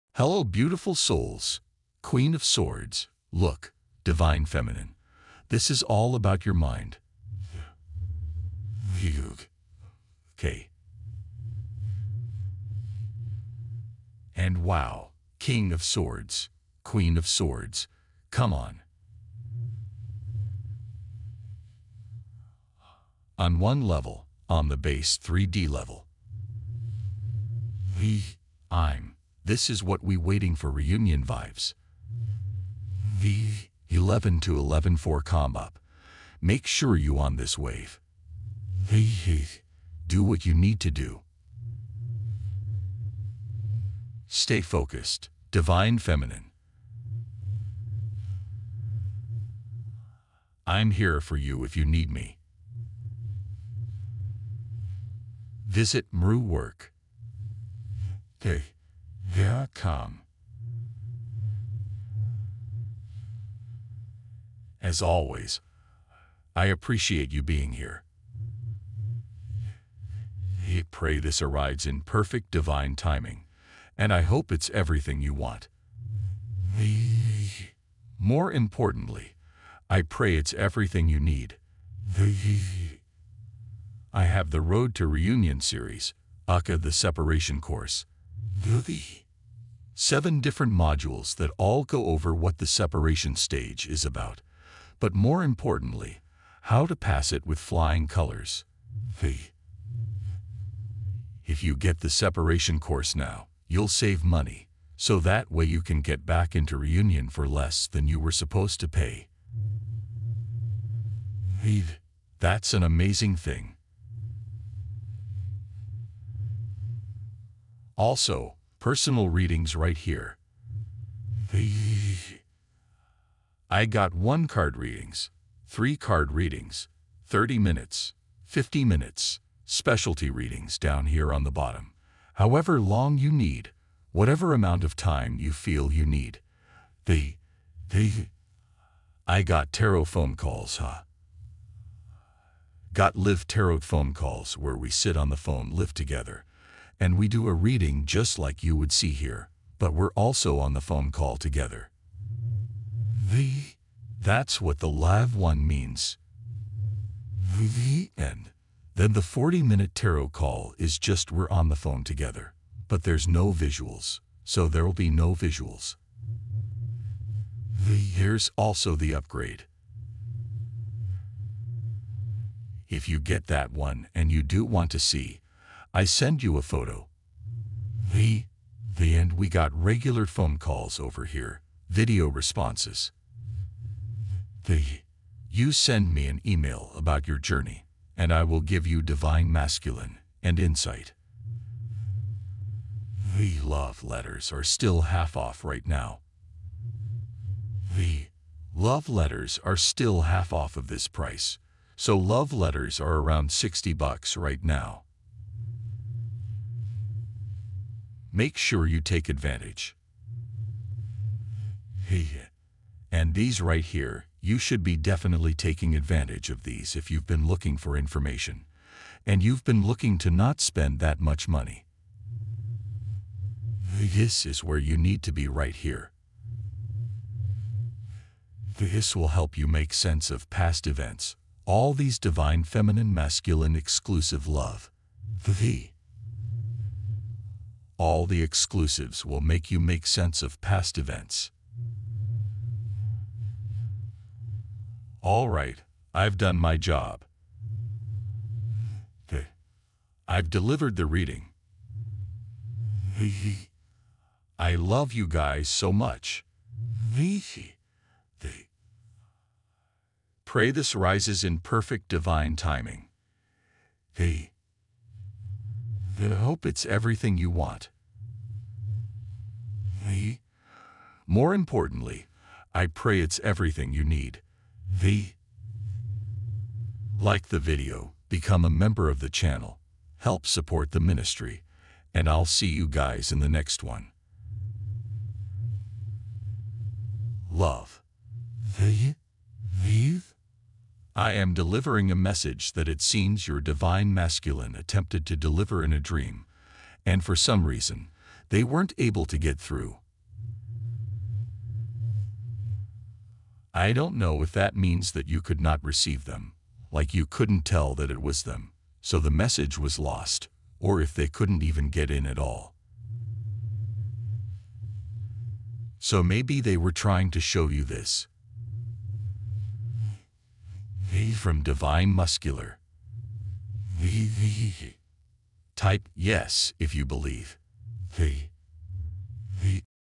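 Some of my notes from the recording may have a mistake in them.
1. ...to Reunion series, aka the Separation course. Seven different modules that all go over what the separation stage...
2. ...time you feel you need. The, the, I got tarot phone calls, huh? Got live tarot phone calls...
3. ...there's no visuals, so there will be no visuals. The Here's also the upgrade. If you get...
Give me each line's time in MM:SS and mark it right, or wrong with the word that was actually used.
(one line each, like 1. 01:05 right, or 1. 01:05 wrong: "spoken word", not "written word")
1. 01:24 right
2. 02:14 right
3. 02:43 right.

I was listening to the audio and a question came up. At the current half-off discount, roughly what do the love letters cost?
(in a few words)
$60.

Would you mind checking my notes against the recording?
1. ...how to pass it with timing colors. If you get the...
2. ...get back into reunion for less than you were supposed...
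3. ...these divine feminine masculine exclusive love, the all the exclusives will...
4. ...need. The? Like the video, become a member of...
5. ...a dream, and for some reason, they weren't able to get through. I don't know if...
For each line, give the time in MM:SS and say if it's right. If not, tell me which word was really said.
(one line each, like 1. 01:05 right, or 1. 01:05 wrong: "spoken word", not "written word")
1. 01:36 wrong: "flying", not "timing"
2. 01:46 right
3. 03:51 right
4. 04:34 right
5. 04:55 right.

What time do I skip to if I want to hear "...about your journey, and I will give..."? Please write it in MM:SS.
03:06.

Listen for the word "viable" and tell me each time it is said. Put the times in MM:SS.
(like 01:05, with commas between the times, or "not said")
not said.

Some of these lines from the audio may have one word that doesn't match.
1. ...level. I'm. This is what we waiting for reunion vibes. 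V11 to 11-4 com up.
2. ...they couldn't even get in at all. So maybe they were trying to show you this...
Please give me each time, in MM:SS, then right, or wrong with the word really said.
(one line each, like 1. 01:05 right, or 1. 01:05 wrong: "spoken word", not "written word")
1. 00:25 right
2. 05:11 right.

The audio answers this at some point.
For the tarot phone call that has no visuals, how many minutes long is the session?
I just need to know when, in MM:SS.
02:39.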